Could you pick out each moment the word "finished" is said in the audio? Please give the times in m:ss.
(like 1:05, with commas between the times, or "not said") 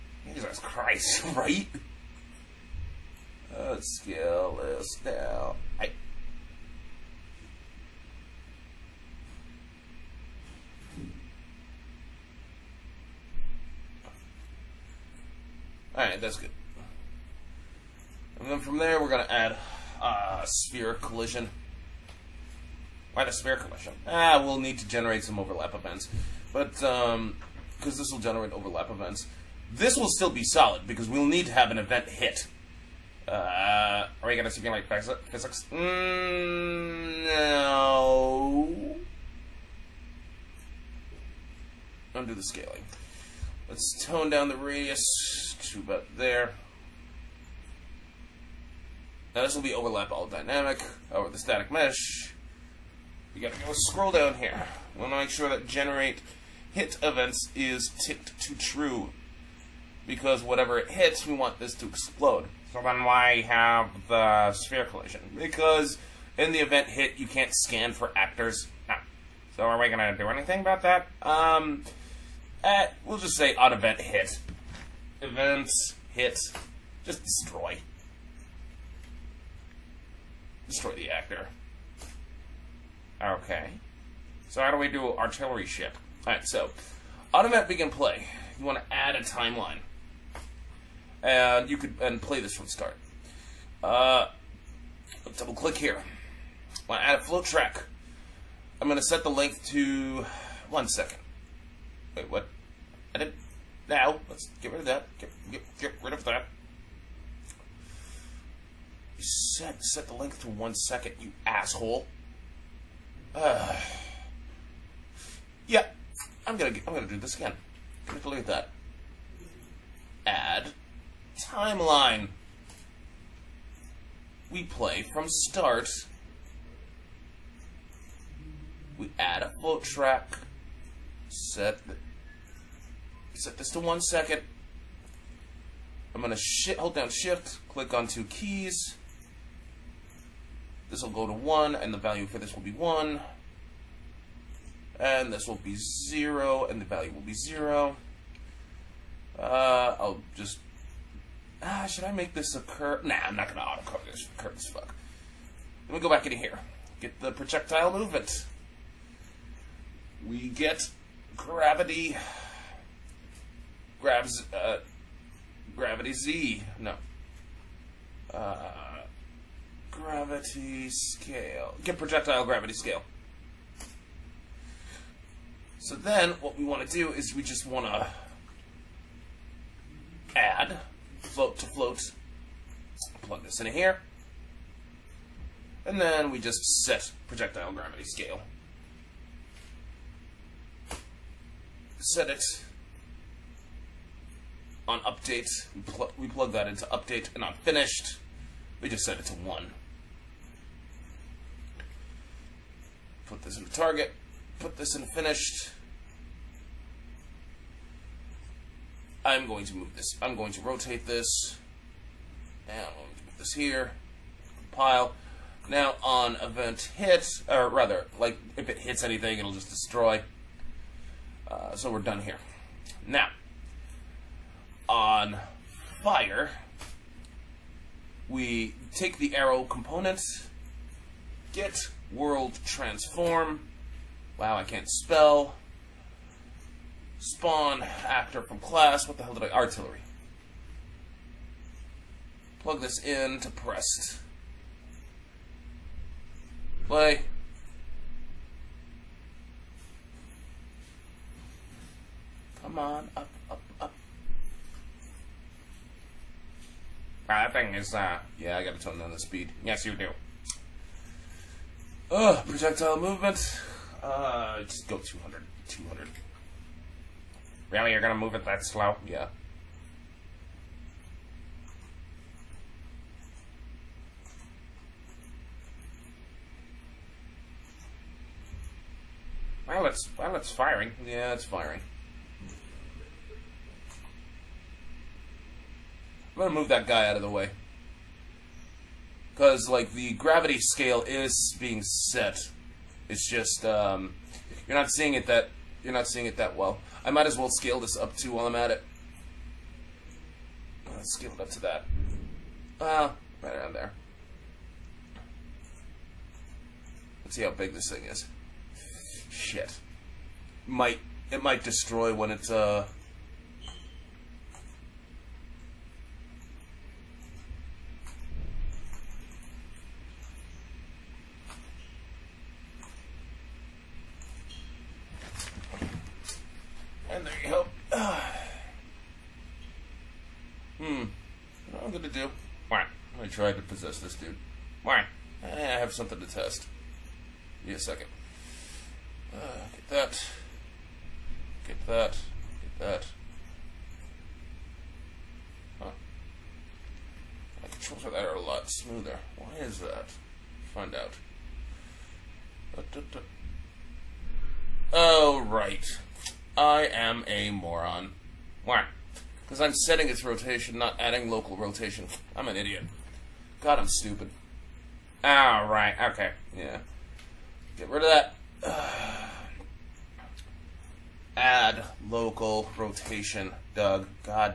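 3:17, 3:25.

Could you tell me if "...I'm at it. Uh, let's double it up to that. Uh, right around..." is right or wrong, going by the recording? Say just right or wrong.
wrong.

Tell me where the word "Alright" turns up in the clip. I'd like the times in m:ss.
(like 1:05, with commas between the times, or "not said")
0:15, 1:26.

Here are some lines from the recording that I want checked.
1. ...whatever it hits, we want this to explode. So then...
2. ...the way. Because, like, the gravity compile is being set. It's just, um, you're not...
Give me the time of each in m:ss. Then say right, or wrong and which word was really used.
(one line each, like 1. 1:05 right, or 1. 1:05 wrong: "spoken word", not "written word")
1. 1:00 right
2. 4:47 wrong: "scale", not "compile".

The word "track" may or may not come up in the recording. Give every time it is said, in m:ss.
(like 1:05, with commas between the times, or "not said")
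1:37, 2:09.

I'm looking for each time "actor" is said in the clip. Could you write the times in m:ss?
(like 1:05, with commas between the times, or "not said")
1:08, 1:21, 3:58.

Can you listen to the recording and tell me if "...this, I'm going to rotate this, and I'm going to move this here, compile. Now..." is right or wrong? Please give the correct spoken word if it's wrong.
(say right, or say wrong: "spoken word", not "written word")
right.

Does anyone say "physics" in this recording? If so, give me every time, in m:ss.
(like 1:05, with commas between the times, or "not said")
0:34.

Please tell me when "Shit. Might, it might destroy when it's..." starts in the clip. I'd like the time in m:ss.
5:09.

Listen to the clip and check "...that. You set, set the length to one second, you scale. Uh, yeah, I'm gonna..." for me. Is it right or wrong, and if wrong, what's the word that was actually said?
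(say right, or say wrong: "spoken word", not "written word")
wrong: "asshole", not "scale".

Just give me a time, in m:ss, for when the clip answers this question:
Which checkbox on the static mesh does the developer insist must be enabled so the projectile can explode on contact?
0:55.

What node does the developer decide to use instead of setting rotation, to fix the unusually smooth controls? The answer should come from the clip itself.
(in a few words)
Add local rotation.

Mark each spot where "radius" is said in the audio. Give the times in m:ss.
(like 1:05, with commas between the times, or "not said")
0:44.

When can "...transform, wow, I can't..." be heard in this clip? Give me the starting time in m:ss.
3:52.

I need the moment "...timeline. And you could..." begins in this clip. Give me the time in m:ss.
1:29.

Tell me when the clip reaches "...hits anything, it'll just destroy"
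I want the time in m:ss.
3:38.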